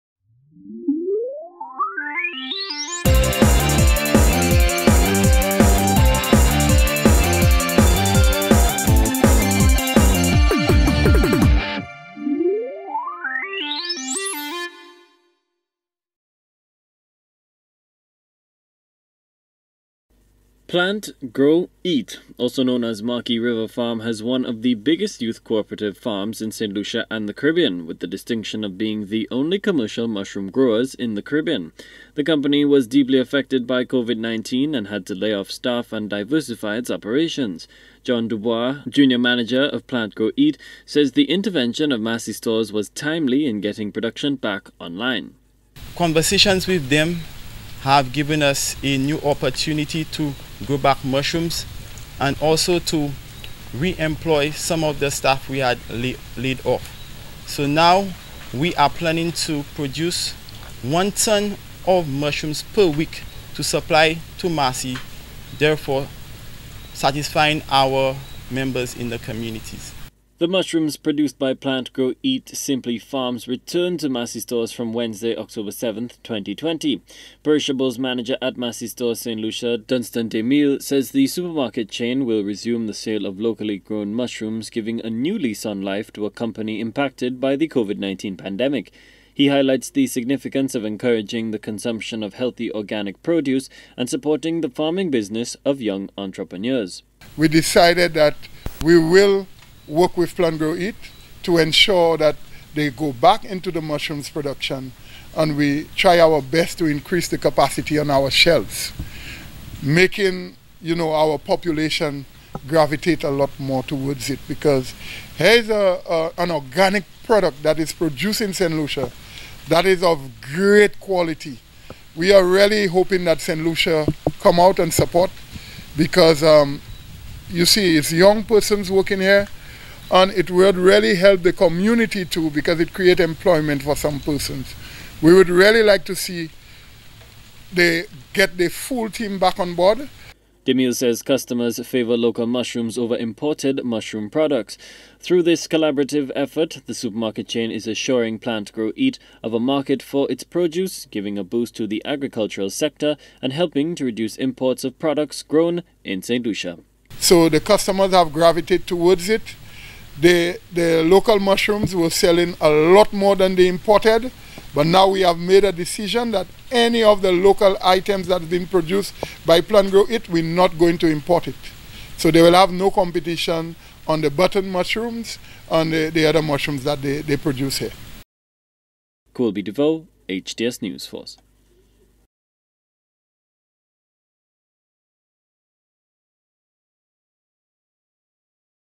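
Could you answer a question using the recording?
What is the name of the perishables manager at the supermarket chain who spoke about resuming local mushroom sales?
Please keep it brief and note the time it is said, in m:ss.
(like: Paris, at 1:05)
Dunstan DeMille, at 1:19.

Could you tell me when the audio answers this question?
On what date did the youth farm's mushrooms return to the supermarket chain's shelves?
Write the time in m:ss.
1:15.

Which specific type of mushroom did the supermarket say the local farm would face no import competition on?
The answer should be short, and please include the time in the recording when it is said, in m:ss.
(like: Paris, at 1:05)
Button mushrooms, at 2:54.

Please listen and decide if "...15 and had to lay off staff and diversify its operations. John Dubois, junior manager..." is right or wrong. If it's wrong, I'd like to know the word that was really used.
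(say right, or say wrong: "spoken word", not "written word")
wrong: "19", not "15".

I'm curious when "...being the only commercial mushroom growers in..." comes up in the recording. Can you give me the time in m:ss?
0:28.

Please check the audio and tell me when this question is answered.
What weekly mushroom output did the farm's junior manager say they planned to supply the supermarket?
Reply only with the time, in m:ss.
1:00.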